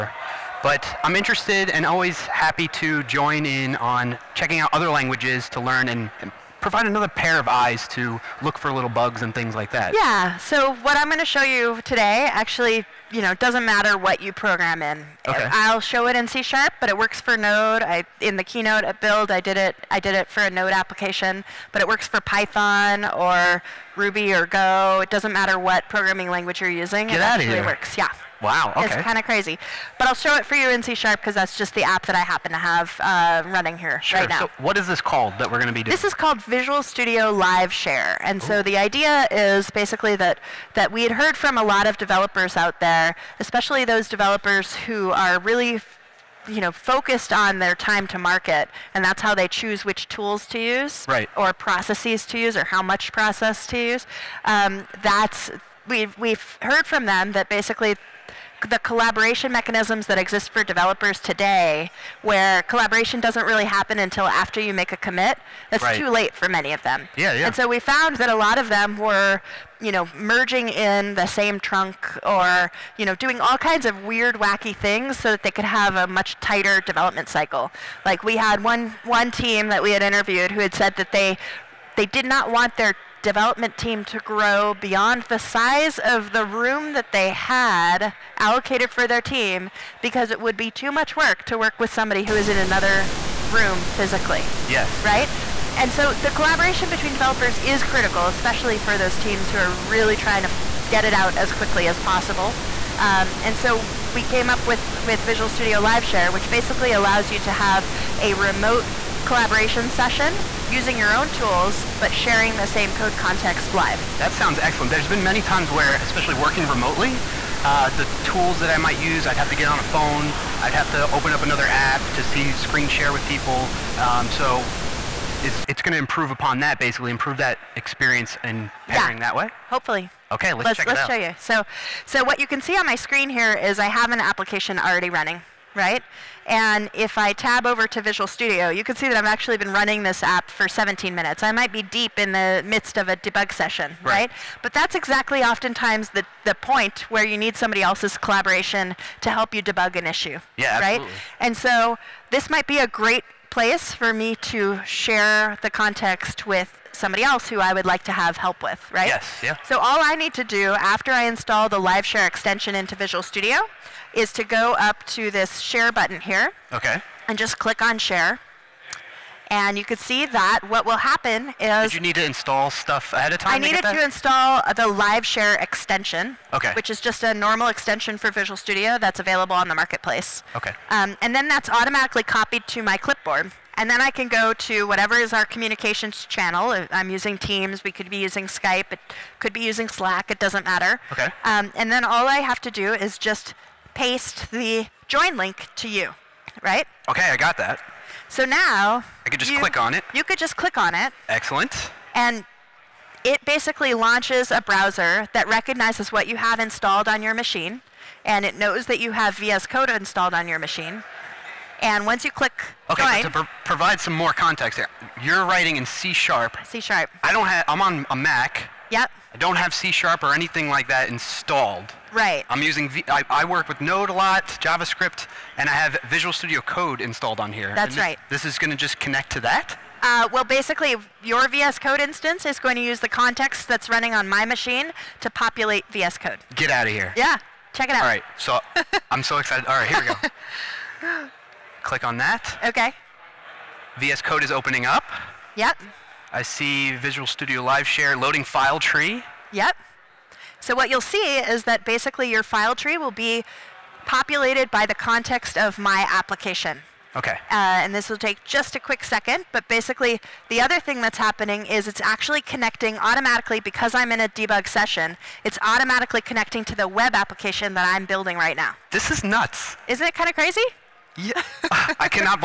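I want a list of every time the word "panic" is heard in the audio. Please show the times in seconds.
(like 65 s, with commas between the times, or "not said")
not said.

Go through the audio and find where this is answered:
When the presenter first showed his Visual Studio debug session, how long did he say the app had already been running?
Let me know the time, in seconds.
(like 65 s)
140 s.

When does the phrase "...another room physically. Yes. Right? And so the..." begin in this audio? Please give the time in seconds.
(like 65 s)
92 s.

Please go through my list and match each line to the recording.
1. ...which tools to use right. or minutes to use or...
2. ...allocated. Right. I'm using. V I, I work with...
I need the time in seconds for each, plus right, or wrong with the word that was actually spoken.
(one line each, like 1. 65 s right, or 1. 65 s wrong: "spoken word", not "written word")
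1. 49 s wrong: "processes", not "minutes"
2. 221 s wrong: "installed", not "allocated".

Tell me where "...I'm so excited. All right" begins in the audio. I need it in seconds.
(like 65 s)
239 s.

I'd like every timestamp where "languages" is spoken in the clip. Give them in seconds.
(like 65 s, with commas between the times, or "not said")
4 s, 26 s.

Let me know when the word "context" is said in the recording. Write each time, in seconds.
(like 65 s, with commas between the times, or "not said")
113 s, 155 s, 214 s, 233 s, 254 s.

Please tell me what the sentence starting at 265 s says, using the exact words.
It's automatically connecting to the web application that I'm building right now.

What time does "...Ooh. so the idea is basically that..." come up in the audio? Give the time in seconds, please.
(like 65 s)
38 s.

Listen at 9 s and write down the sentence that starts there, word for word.
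Yeah, so what I'm going to show you today actually, you know, doesn't matter what you program in.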